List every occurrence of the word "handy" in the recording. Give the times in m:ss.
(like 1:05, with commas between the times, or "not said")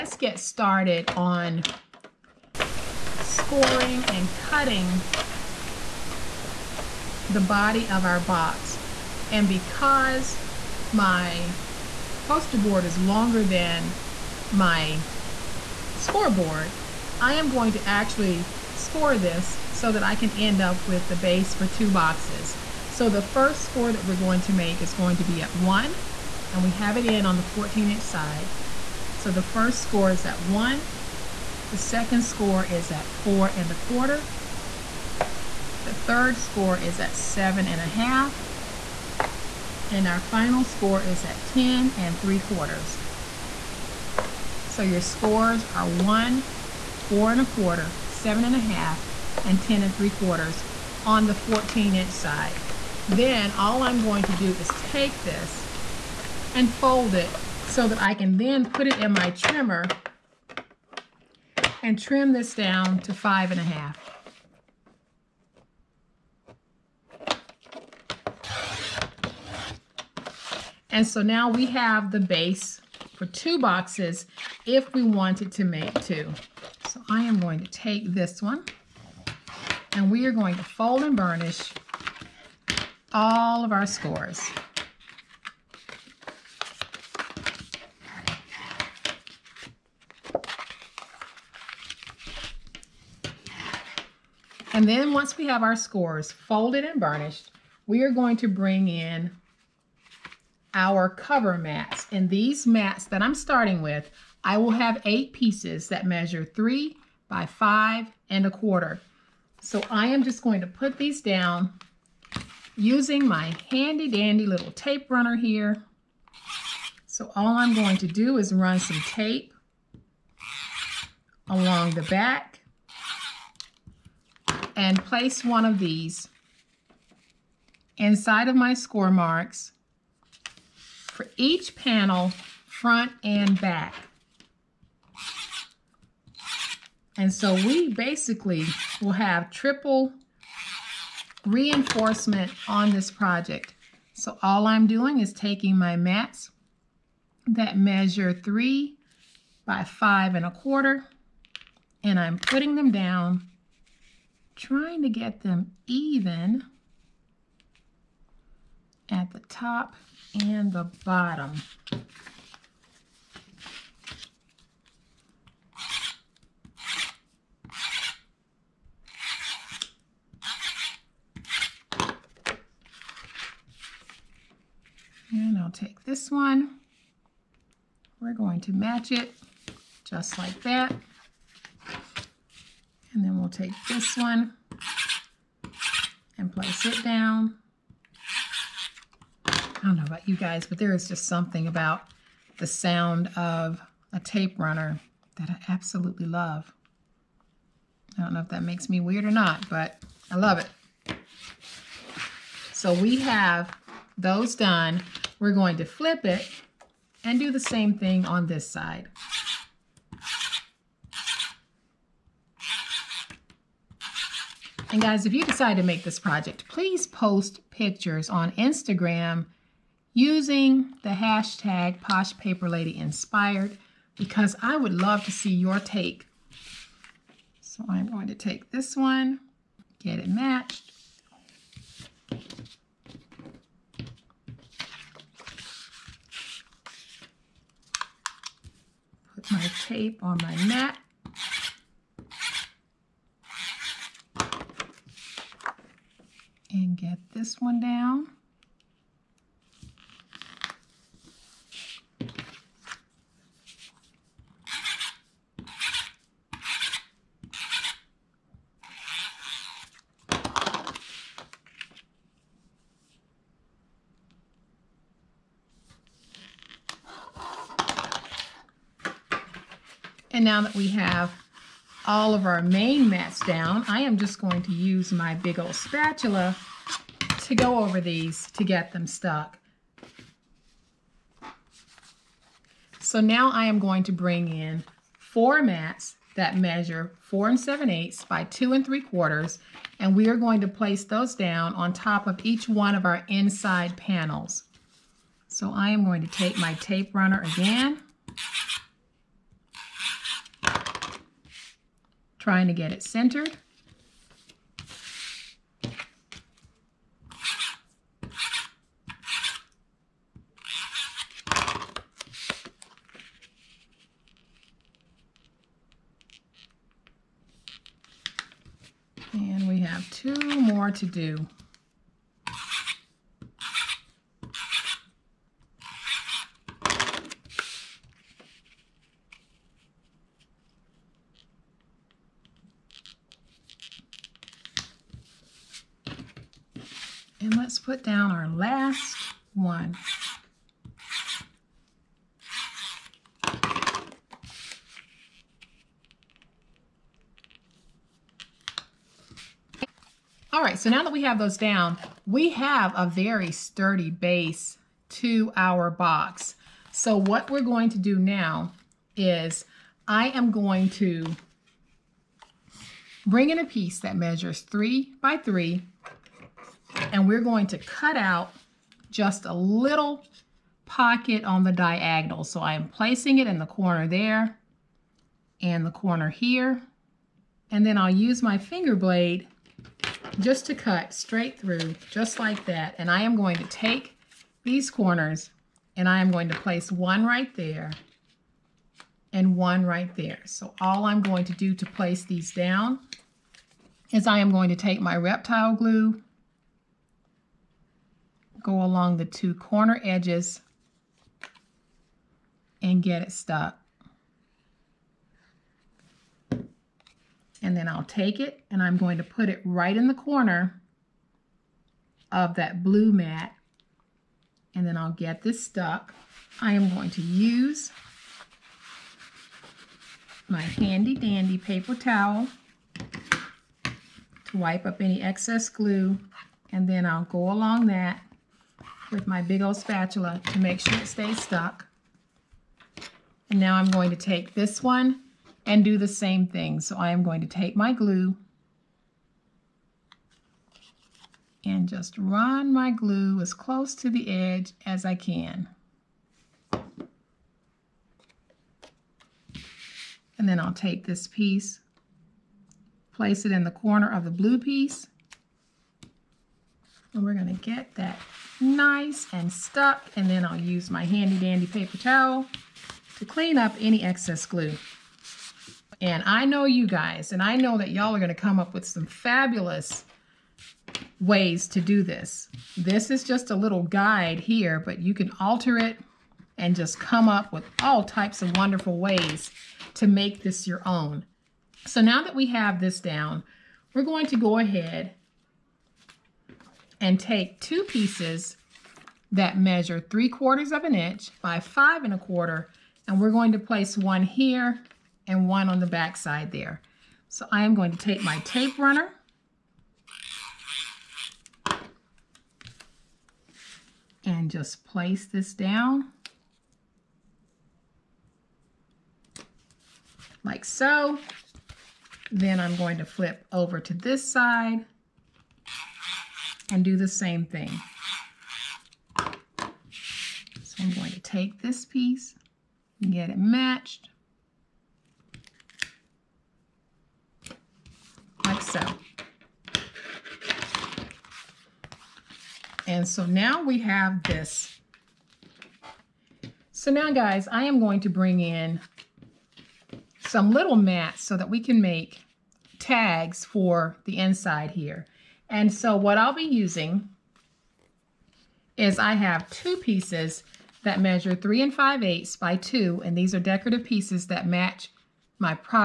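1:53, 7:00, 7:41.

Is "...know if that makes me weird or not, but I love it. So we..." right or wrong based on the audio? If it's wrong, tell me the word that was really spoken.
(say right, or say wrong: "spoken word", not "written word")
right.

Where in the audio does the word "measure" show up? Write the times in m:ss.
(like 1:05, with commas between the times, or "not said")
1:46, 2:27, 4:46, 6:04, 8:09, 9:10.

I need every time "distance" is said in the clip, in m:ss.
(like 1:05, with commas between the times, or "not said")
not said.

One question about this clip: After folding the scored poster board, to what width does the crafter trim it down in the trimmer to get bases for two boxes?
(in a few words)
5 1/2.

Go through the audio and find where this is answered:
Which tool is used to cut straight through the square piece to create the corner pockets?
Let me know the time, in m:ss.
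6:18.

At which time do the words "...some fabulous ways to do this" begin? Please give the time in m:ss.
7:48.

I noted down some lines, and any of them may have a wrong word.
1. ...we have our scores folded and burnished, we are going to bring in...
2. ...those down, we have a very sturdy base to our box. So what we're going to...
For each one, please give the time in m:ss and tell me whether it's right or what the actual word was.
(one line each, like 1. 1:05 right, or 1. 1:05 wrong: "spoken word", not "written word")
1. 1:35 right
2. 5:51 right.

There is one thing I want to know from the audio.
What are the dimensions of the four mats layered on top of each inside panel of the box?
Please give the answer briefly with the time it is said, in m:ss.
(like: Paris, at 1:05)
4 7/8 by 2 3/4, at 4:47.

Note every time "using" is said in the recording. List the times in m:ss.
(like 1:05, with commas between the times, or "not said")
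1:52, 3:40, 9:06.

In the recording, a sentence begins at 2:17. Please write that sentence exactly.
And so we basically will have triple reinforcement on this project.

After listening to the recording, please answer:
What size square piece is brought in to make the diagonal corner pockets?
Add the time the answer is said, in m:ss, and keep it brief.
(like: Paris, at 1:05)
3 by 3, at 6:04.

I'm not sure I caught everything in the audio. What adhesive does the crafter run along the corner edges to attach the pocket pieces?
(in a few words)
reptile glue.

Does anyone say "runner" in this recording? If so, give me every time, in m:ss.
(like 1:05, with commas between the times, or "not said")
1:55, 3:14, 4:57, 8:18.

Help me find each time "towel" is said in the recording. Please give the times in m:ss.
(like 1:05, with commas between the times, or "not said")
7:01, 7:41.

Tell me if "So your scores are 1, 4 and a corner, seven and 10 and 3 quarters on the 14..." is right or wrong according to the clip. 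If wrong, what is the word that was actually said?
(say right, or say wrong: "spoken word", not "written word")
wrong: "quarter", not "corner".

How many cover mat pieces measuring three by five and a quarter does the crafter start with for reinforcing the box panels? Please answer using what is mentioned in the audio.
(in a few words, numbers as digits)
8.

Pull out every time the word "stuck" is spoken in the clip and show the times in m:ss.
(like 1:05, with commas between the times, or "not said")
4:39, 6:43, 6:55, 7:11, 7:39.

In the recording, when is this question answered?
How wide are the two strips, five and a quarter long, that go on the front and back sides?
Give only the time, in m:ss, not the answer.
8:09.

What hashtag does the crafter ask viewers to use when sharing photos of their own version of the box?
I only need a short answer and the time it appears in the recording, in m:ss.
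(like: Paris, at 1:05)
Posh Paper Lady Inspired, at 3:42.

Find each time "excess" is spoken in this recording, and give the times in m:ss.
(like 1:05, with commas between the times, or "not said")
7:05, 7:44.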